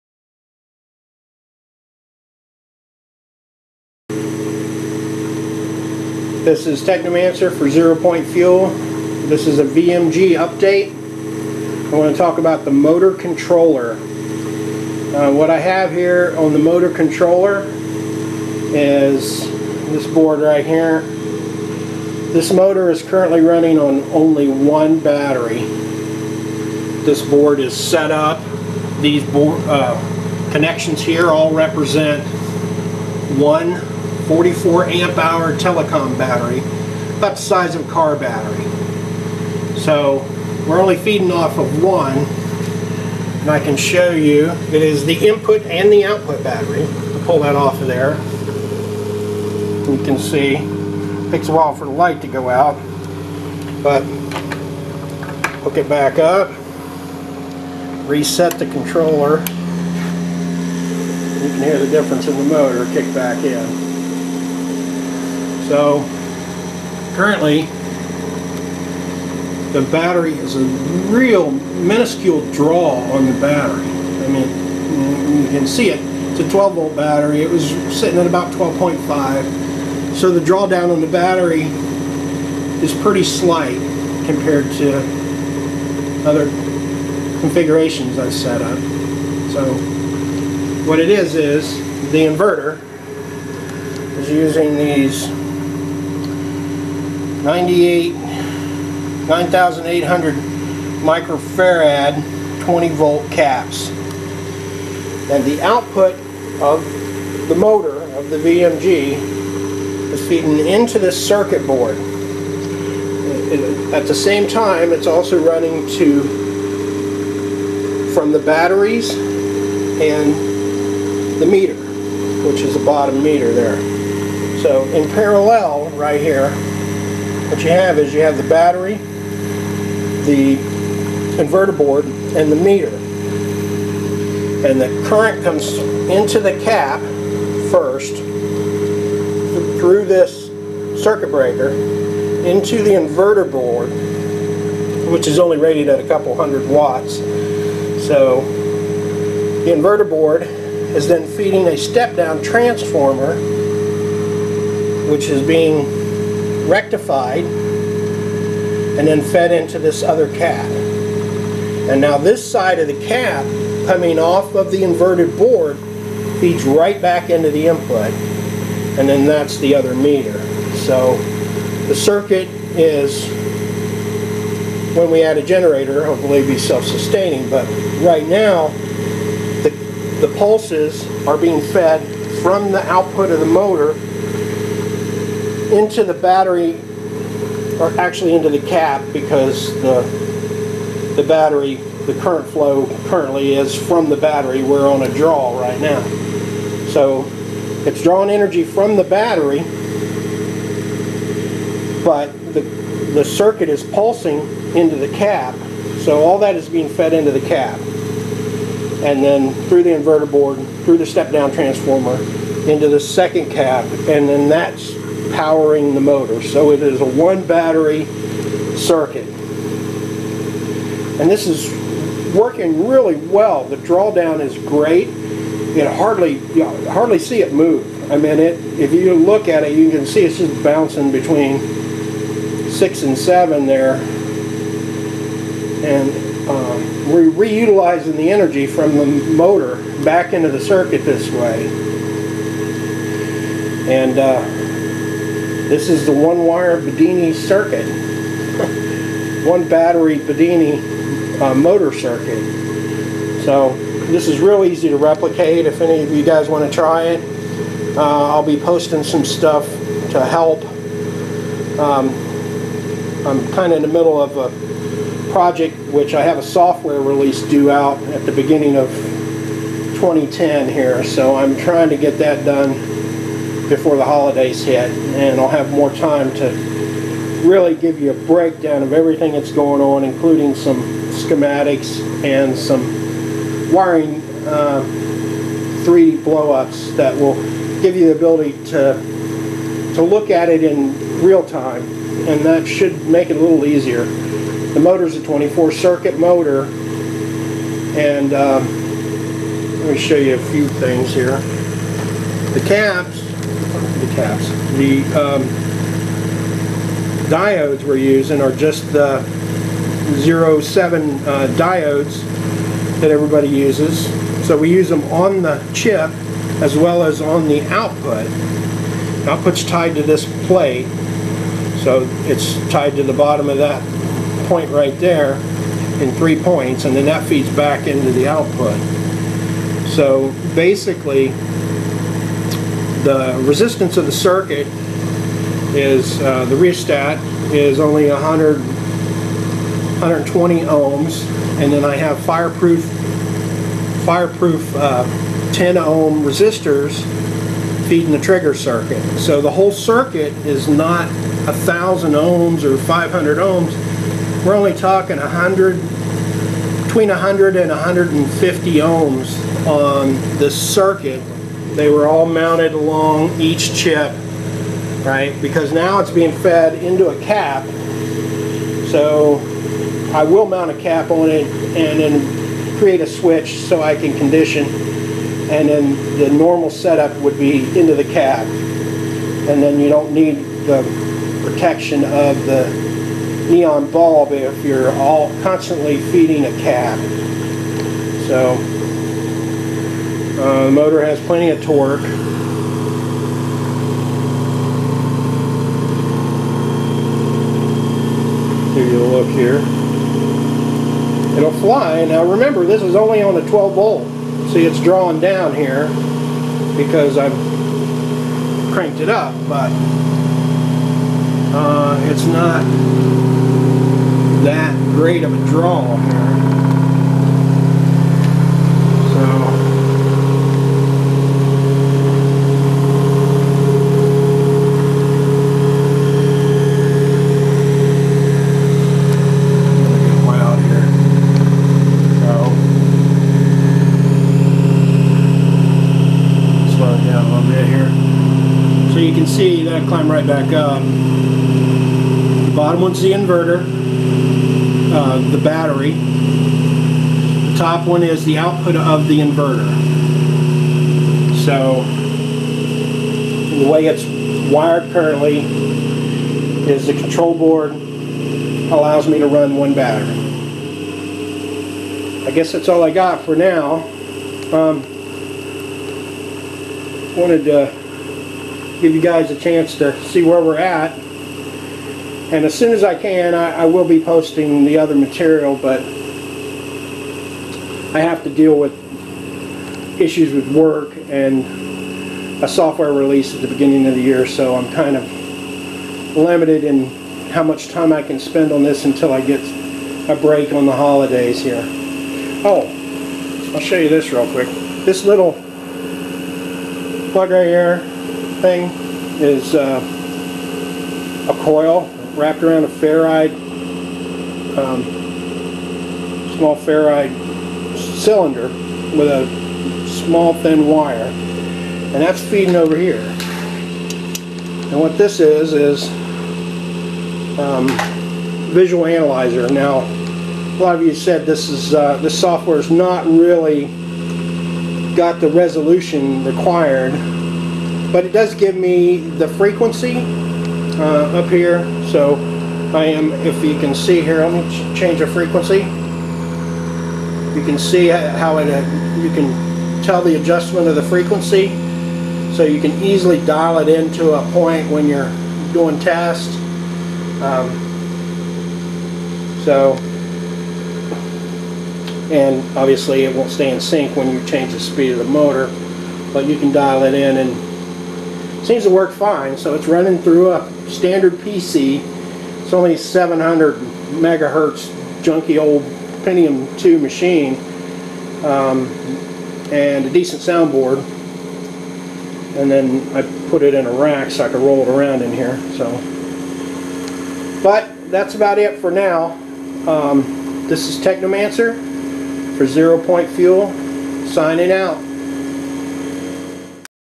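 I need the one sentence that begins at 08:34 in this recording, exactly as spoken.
And what this is, is um, visual analyzer.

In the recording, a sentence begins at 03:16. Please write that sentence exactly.
So it's drawing energy from the battery, but the, the circuit is pulsing into the cap.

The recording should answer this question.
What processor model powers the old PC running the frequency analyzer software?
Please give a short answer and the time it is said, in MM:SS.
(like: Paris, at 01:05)
Pentium 2, at 09:26.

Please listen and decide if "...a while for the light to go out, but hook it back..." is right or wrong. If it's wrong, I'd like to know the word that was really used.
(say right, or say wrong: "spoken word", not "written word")
right.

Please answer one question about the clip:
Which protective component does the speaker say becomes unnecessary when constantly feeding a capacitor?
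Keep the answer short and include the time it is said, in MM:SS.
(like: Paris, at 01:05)
neon bulb, at 06:23.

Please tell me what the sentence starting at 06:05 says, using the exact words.
Because now it's being fed into a cap.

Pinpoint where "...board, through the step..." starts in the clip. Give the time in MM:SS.
03:30.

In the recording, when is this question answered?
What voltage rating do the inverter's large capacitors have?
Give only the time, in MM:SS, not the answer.
01:42.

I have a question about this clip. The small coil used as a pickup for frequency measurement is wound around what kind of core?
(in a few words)
ferrite cylinder.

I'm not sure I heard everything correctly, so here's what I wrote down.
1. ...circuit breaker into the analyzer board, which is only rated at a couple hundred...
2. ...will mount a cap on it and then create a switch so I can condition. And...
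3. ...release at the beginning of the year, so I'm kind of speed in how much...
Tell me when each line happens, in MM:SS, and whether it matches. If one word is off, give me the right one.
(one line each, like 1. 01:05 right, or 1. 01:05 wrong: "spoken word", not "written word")
1. 02:21 wrong: "inverter", not "analyzer"
2. 06:10 right
3. 08:02 wrong: "limited", not "speed".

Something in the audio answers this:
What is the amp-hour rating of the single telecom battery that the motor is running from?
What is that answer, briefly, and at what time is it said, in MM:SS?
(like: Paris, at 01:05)
44 amp hour, at 00:34.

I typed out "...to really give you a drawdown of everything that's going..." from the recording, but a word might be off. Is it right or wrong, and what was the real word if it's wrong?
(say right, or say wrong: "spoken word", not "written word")
wrong: "breakdown", not "drawdown".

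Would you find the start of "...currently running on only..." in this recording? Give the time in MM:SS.
00:23.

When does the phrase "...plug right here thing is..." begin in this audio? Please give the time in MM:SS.
08:17.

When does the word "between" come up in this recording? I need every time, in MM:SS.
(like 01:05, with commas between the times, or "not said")
03:51, 05:56.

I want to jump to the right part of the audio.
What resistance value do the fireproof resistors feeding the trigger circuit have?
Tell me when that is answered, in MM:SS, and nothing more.
05:45.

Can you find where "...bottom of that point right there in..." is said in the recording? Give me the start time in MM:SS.
05:23.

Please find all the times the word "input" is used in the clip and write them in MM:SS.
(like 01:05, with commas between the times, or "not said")
00:45, 02:47.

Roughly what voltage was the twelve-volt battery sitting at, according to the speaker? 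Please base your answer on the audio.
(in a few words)
12.5.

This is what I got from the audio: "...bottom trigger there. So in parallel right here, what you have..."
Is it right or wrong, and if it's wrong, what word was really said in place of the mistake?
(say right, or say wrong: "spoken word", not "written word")
wrong: "meter", not "trigger".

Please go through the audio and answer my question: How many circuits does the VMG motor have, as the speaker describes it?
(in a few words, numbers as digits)
24.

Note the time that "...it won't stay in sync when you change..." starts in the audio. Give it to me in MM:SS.
09:13.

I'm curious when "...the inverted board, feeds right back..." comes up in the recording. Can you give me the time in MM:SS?
02:44.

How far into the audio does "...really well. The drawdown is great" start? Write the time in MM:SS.
03:42.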